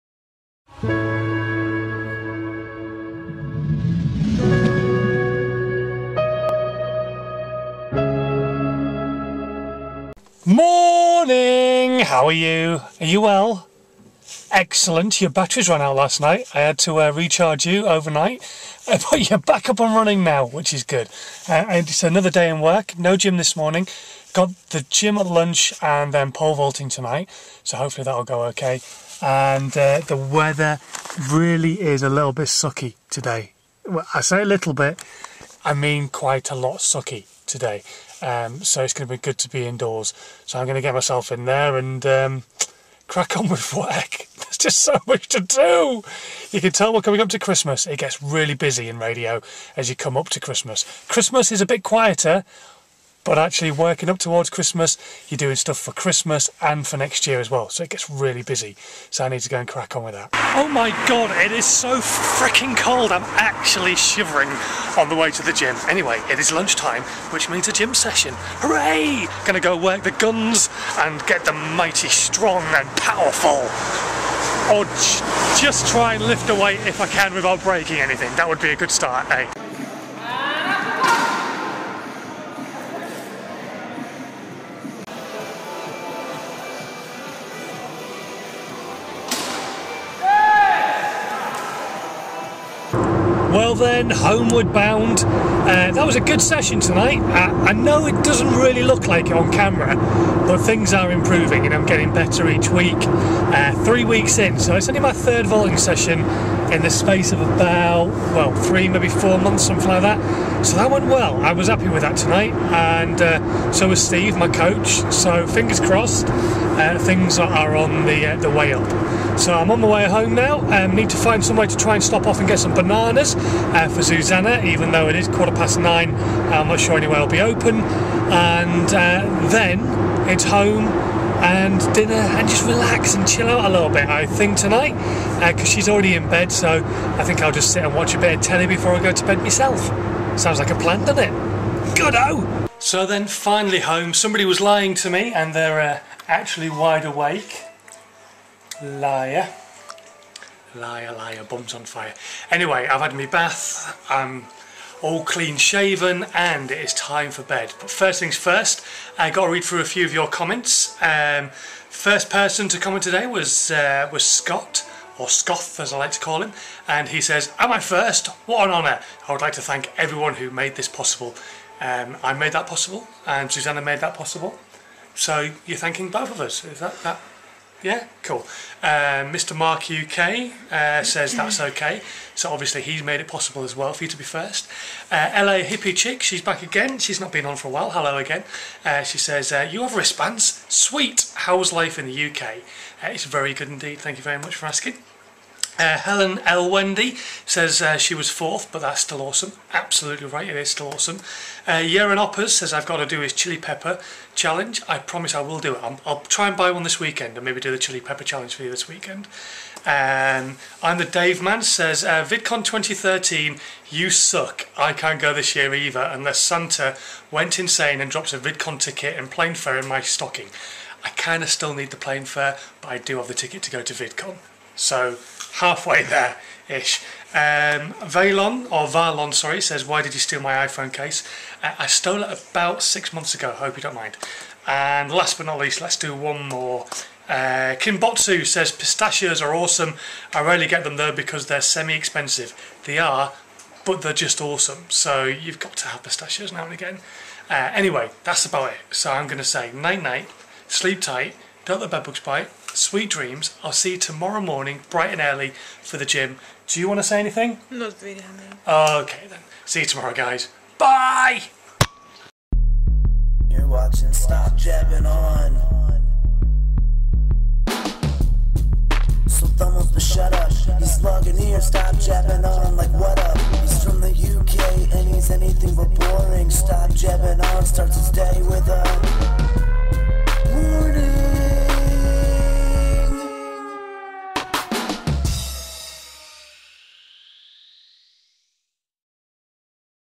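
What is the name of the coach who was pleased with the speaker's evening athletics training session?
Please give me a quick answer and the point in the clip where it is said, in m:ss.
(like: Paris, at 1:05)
Steve, at 1:54.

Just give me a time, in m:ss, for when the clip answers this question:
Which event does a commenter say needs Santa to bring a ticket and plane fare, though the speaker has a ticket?
3:32.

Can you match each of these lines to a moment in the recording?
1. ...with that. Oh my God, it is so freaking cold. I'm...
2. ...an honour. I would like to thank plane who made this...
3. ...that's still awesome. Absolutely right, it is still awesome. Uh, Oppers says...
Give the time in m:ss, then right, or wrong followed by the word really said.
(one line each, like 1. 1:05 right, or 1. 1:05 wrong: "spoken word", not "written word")
1. 1:00 right
2. 2:48 wrong: "everyone", not "plane"
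3. 3:18 right.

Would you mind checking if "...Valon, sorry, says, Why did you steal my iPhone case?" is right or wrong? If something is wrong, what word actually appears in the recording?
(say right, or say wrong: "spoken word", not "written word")
right.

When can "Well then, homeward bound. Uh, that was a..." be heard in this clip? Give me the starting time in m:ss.
1:33.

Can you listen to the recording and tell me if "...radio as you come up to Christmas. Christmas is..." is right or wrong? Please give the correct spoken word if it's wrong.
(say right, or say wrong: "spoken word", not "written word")
right.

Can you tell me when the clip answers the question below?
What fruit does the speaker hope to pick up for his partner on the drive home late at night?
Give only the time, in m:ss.
2:02.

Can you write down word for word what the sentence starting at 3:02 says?
So obviously he's made it possible as well for you to be first.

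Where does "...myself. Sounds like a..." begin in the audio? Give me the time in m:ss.
2:19.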